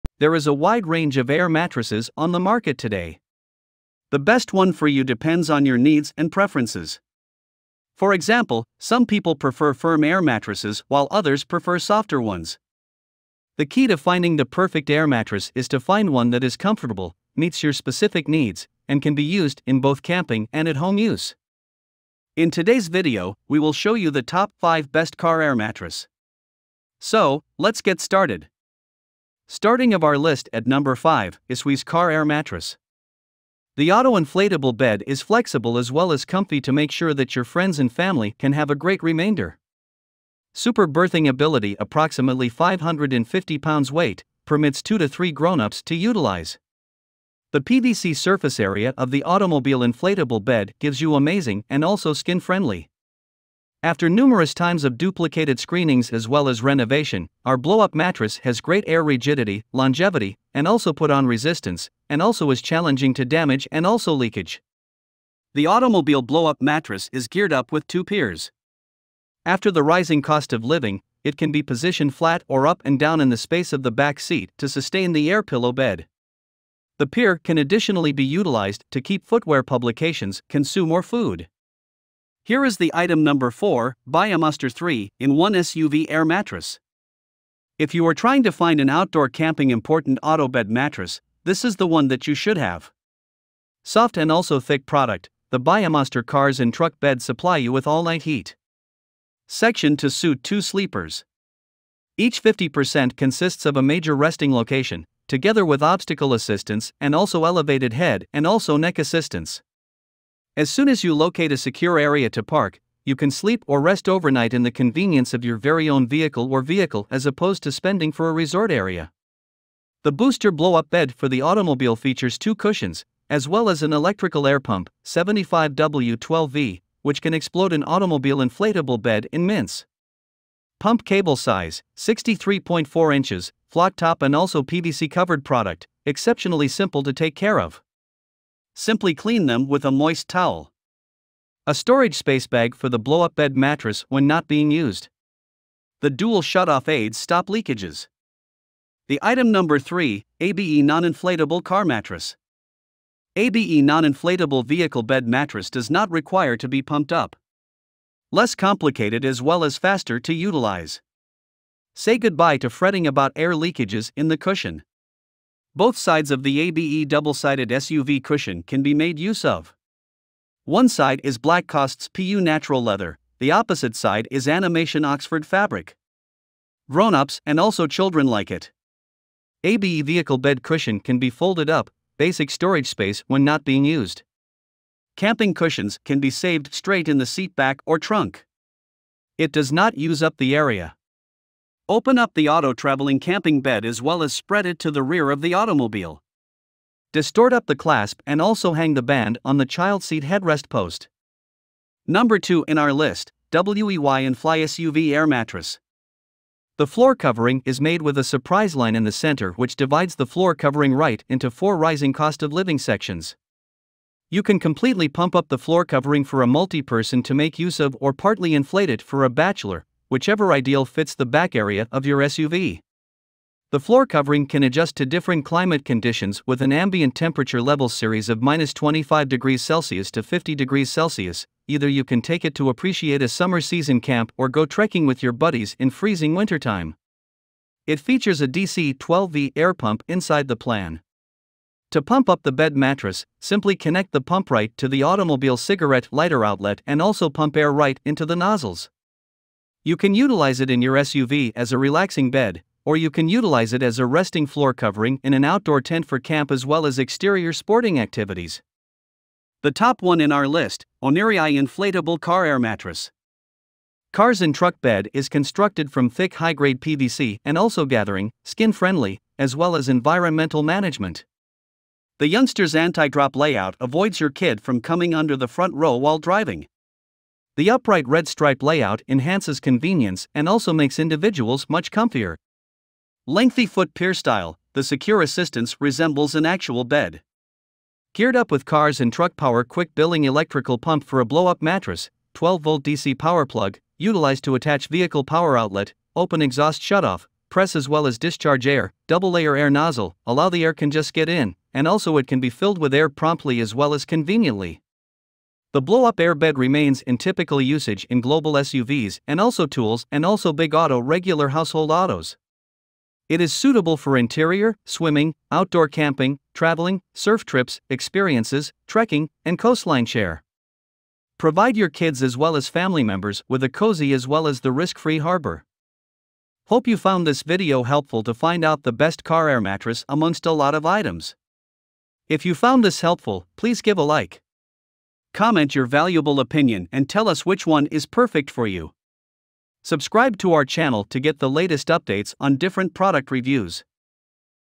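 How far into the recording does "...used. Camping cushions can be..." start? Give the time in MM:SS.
03:03.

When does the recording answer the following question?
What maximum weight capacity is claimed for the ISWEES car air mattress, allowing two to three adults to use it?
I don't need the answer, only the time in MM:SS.
00:42.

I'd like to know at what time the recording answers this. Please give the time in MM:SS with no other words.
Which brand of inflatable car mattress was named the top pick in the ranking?
04:21.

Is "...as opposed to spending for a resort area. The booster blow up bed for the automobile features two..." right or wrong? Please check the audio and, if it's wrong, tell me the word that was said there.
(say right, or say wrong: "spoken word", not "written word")
right.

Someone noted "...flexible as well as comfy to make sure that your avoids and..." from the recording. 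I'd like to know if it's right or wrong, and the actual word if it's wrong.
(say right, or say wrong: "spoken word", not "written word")
wrong: "friends", not "avoids".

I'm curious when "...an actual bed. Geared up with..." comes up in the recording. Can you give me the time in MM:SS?
04:46.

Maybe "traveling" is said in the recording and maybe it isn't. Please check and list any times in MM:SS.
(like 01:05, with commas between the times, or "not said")
03:12, 05:16.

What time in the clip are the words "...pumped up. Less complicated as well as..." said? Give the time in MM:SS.
02:36.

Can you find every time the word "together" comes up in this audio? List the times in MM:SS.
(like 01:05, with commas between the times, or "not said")
01:45.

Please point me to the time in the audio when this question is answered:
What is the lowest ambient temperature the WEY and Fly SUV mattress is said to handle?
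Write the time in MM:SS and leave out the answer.
03:48.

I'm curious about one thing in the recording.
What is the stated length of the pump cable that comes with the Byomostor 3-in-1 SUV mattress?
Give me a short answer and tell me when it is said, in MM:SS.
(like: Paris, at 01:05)
63.4 inches, at 02:11.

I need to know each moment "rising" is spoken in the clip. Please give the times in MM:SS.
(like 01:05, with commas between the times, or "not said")
01:09, 03:31.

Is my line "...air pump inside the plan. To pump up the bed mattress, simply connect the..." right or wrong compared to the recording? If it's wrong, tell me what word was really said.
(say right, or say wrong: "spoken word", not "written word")
right.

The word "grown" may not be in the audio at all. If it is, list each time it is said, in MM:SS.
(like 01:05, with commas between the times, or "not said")
00:45, 02:56.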